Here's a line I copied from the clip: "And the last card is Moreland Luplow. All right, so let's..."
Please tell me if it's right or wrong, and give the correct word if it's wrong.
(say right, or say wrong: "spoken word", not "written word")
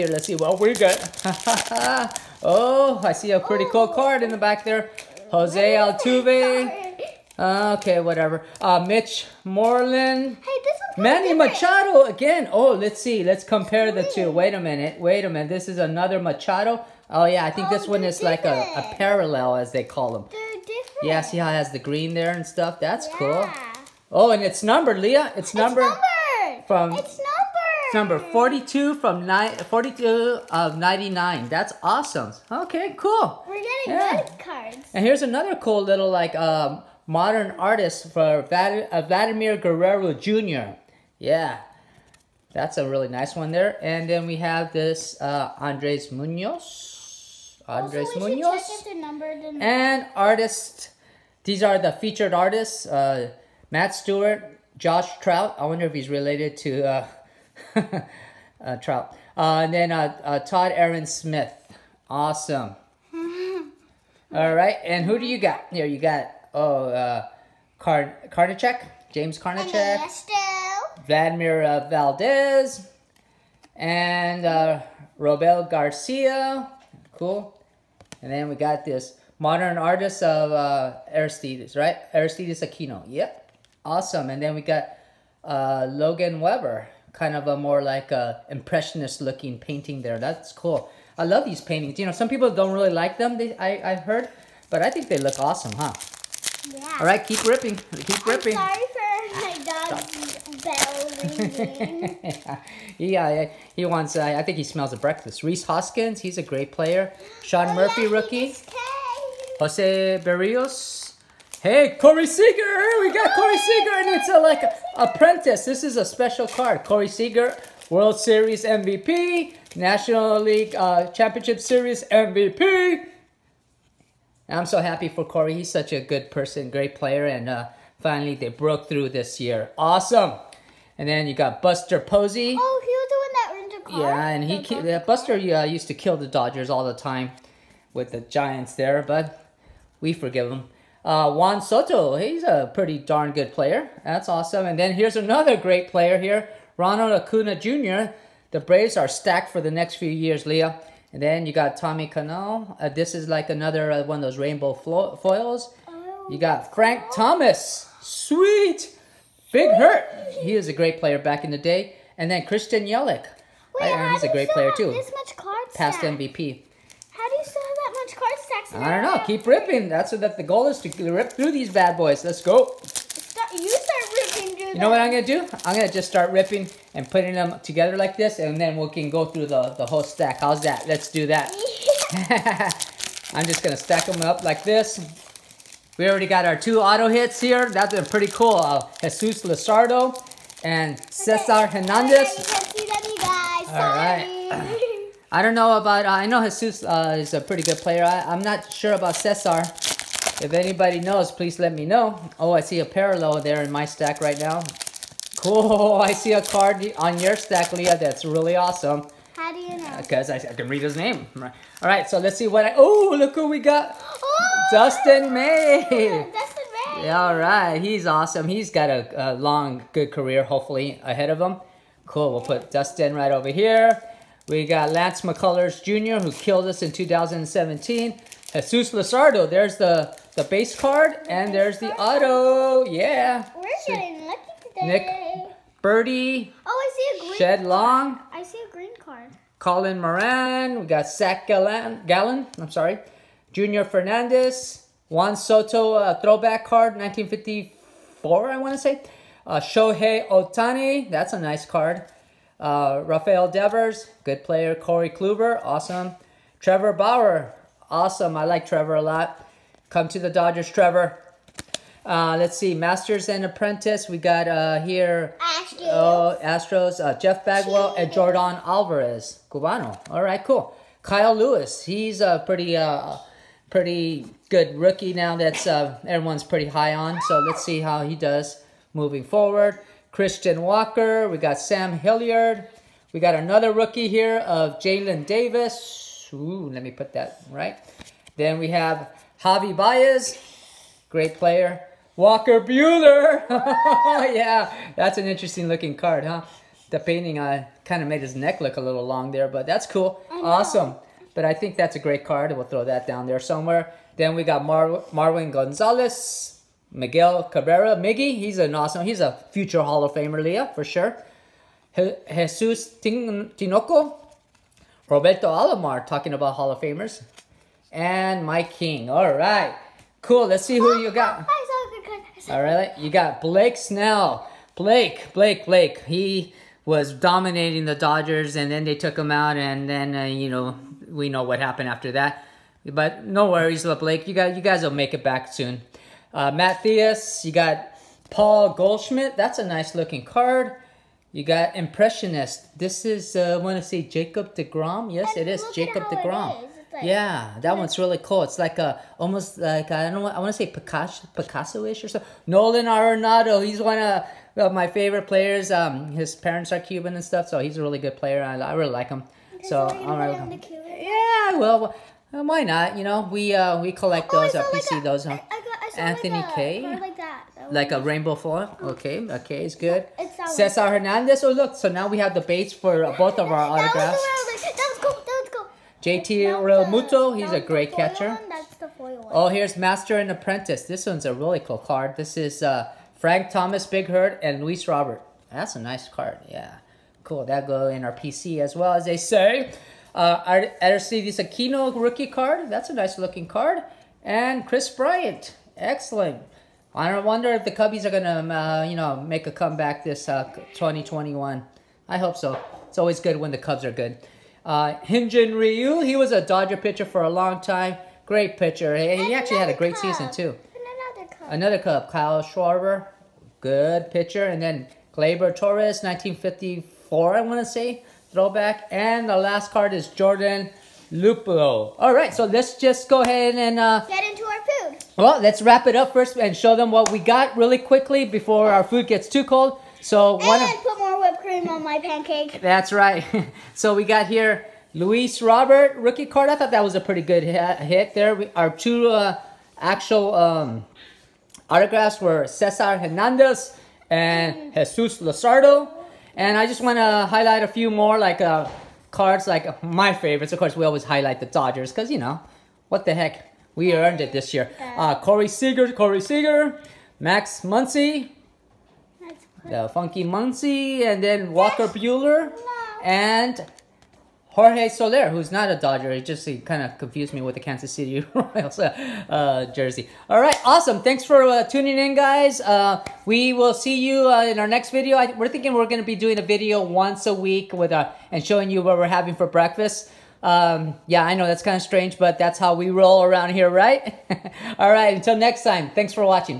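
wrong: "Jordan", not "Moreland".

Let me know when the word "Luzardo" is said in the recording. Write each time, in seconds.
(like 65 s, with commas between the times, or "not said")
189 s, 228 s, 445 s.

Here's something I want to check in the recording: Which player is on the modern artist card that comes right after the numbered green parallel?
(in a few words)
Vladimir Guerrero Jr.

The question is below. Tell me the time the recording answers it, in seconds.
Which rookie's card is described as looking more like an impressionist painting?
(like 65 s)
85 s.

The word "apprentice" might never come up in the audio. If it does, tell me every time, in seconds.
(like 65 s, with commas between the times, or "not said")
114 s, 263 s, 380 s.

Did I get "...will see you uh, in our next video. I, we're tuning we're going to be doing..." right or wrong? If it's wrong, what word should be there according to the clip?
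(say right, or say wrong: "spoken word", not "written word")
wrong: "thinking", not "tuning".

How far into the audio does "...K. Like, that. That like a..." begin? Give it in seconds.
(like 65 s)
366 s.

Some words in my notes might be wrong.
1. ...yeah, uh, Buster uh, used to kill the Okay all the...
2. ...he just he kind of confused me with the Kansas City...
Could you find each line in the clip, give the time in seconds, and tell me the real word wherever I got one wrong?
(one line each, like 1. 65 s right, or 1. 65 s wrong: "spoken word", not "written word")
1. 134 s wrong: "Dodgers", not "Okay"
2. 466 s right.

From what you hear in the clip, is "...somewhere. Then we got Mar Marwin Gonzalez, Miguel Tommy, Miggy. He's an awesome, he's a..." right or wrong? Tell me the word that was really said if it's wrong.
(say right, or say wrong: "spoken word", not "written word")
wrong: "Cabrera", not "Tommy".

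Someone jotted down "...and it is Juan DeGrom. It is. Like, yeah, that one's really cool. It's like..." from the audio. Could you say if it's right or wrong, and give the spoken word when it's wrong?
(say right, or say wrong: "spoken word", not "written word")
wrong: "Jacob", not "Juan".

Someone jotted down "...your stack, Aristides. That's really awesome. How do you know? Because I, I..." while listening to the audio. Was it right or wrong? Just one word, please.
wrong.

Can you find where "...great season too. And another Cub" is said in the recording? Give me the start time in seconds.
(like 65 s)
409 s.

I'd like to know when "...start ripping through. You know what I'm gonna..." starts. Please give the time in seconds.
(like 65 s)
173 s.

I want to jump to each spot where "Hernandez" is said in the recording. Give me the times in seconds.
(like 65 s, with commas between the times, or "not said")
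191 s, 370 s, 442 s.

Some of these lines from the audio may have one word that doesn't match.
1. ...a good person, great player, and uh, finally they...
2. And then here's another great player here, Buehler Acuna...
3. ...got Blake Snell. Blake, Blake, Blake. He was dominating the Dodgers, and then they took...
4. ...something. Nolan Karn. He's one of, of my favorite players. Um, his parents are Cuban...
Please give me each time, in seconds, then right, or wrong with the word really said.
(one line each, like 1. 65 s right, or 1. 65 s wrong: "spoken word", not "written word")
1. 125 s right
2. 144 s wrong: "Ronald", not "Buehler"
3. 323 s right
4. 352 s wrong: "Arenado", not "Karn".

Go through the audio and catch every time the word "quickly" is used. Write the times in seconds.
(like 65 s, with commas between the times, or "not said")
427 s.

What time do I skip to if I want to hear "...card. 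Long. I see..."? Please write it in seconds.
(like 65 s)
237 s.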